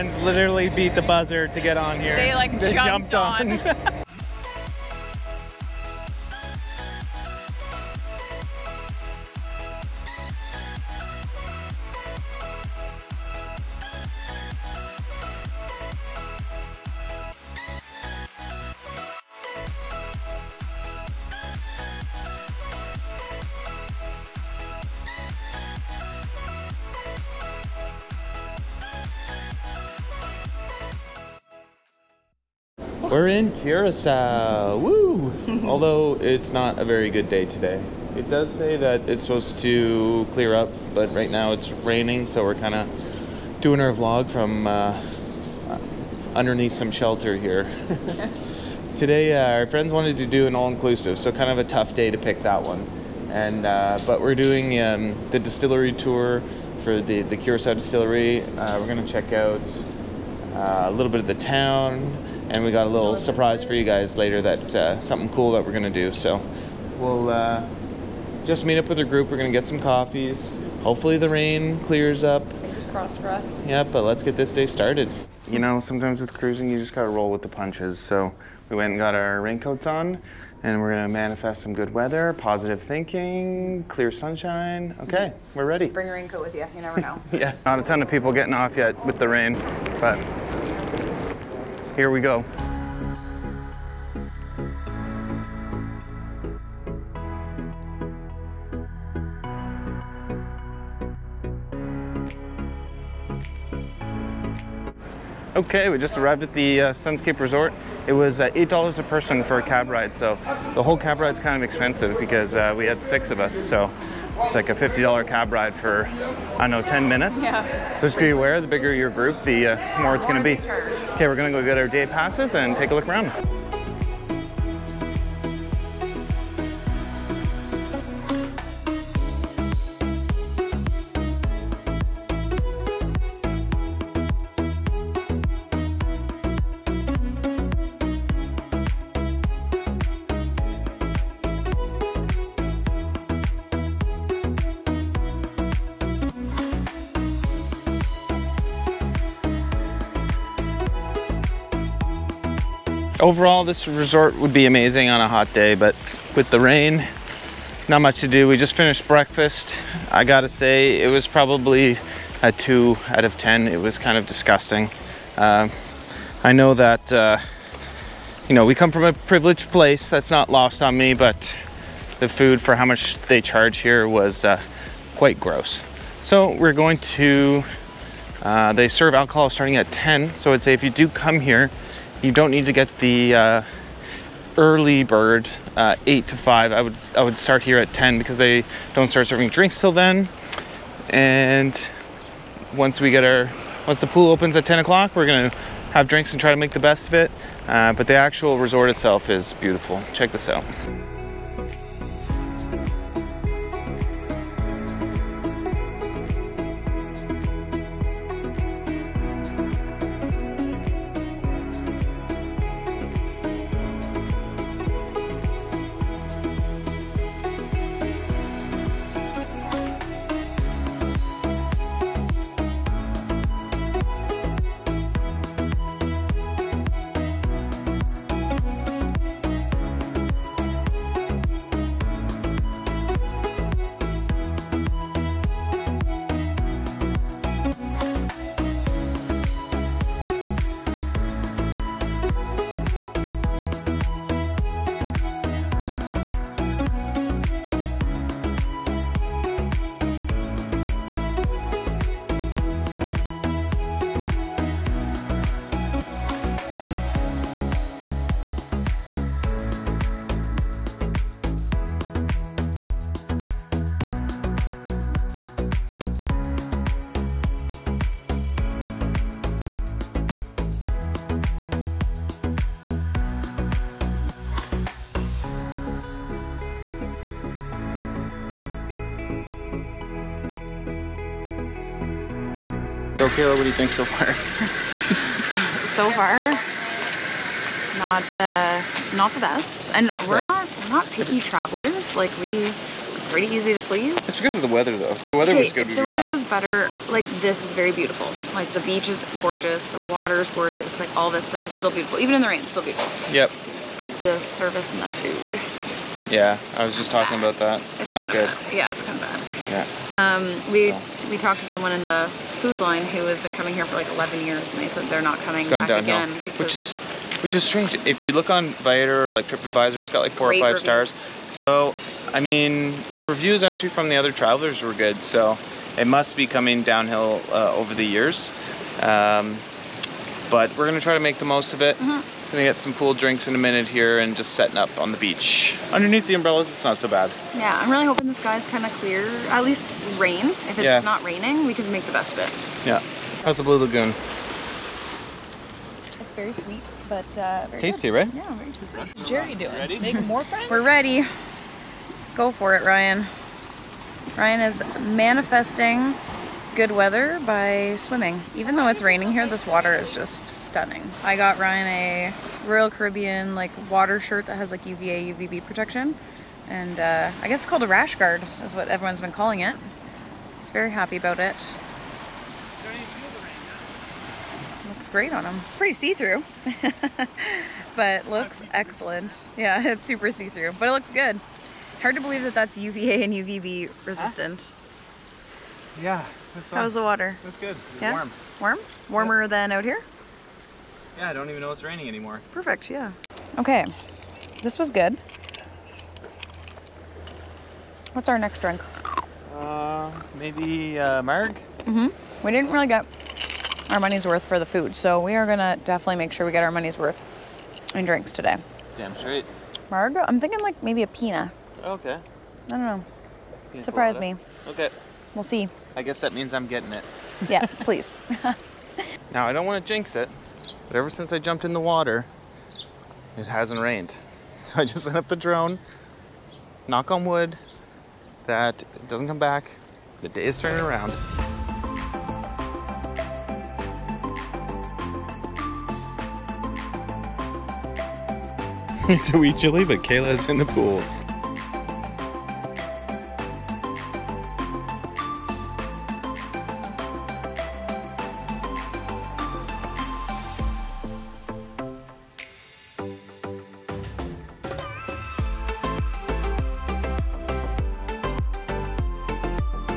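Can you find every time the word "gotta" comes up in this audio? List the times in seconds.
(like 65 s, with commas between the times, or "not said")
76 s, 160 s.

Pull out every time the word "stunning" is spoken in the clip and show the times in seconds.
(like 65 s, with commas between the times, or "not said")
360 s.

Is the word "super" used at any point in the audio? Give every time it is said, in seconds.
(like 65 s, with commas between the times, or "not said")
380 s.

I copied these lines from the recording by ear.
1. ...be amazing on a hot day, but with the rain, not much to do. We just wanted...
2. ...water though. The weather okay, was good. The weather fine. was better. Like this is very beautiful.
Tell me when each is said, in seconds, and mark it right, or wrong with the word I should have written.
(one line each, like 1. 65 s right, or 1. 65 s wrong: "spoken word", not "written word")
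1. 154 s wrong: "finished", not "wanted"
2. 294 s wrong: "weather", not "water".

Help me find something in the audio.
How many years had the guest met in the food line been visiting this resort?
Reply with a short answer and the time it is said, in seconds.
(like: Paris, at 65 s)
11 years, at 314 s.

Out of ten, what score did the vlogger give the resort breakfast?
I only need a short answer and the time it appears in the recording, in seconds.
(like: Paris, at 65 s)
2, at 162 s.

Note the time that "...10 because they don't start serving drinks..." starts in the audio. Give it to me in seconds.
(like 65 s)
187 s.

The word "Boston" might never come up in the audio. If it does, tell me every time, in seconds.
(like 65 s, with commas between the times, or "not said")
not said.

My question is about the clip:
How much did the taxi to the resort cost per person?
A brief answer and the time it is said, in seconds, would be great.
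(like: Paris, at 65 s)
$8, at 108 s.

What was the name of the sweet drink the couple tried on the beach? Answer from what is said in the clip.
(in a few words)
Blue Lagoon.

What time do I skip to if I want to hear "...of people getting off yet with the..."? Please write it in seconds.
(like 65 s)
87 s.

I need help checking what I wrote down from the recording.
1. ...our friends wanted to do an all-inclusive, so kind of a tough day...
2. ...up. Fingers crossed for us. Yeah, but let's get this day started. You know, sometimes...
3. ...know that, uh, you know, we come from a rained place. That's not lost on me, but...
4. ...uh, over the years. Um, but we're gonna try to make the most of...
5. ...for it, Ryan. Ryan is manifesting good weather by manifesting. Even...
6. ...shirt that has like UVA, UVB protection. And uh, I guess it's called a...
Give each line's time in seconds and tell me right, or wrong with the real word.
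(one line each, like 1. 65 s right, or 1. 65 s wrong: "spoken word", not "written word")
1. 49 s right
2. 72 s right
3. 166 s wrong: "privileged", not "rained"
4. 327 s right
5. 352 s wrong: "swimming", not "manifesting"
6. 364 s right.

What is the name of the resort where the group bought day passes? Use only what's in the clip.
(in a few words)
Sunscape Resort.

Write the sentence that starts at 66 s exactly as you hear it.
So we'll uh, just meet up with our group.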